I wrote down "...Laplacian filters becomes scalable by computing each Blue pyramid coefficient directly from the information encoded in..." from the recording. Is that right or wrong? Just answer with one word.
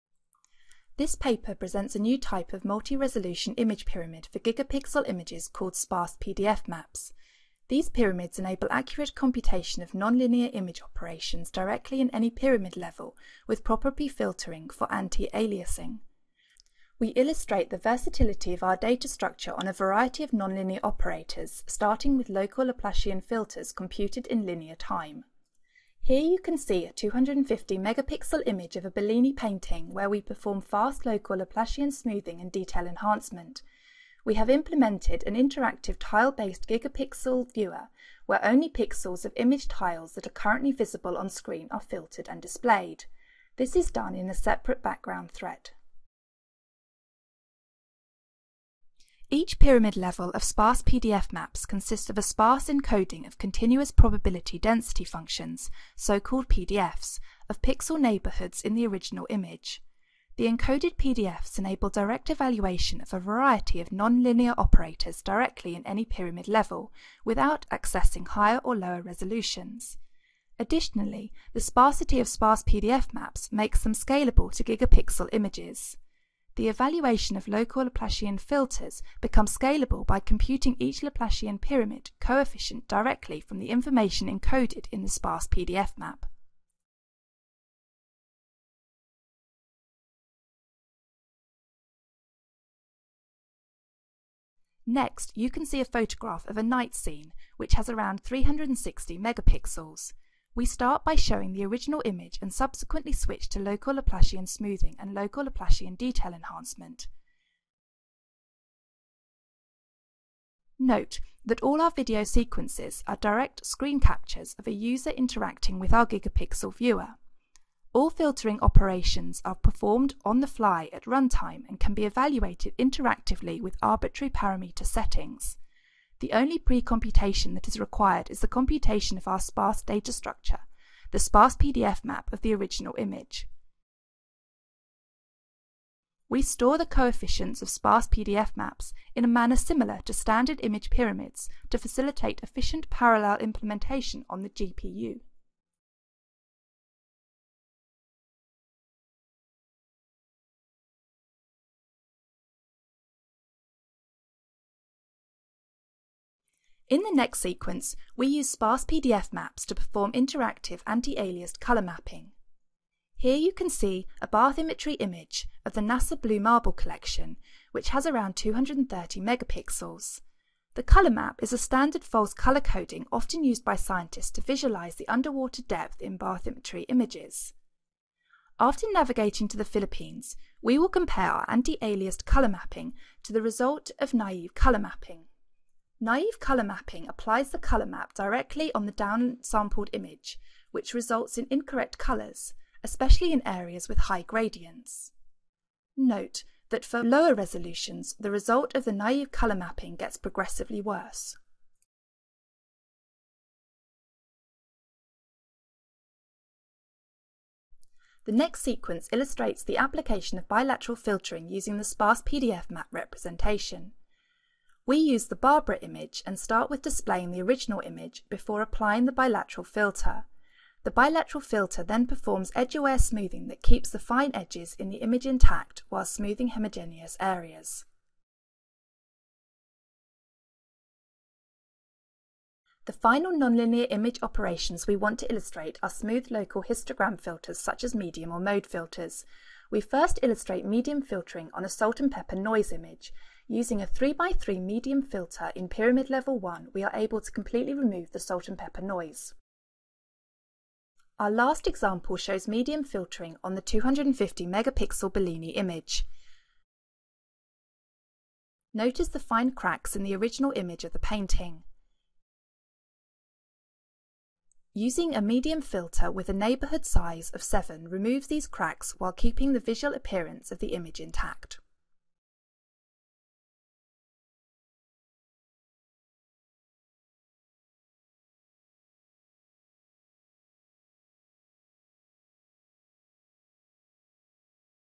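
wrong.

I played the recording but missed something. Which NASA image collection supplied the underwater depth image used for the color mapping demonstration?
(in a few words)
Blue Marble Collection.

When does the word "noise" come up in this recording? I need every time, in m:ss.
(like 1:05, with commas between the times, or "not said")
4:02, 4:08.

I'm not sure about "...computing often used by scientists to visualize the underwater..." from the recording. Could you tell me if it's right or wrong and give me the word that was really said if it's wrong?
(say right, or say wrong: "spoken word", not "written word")
wrong: "coding", not "computing".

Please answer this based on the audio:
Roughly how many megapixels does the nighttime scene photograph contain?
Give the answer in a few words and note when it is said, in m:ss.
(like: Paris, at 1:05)
360 megapixels, at 1:38.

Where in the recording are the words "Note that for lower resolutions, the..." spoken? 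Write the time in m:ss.
3:15.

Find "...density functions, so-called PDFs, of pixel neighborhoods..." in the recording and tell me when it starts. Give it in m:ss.
0:54.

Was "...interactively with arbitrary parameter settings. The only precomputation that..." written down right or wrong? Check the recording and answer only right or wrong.
right.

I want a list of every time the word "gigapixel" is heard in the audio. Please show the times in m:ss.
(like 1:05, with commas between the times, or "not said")
0:04, 0:36, 1:14, 1:56.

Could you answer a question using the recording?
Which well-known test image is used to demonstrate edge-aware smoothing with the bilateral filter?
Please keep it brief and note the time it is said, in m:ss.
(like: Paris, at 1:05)
Barbara, at 3:35.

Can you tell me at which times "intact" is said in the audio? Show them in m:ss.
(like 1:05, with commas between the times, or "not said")
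3:45, 4:31.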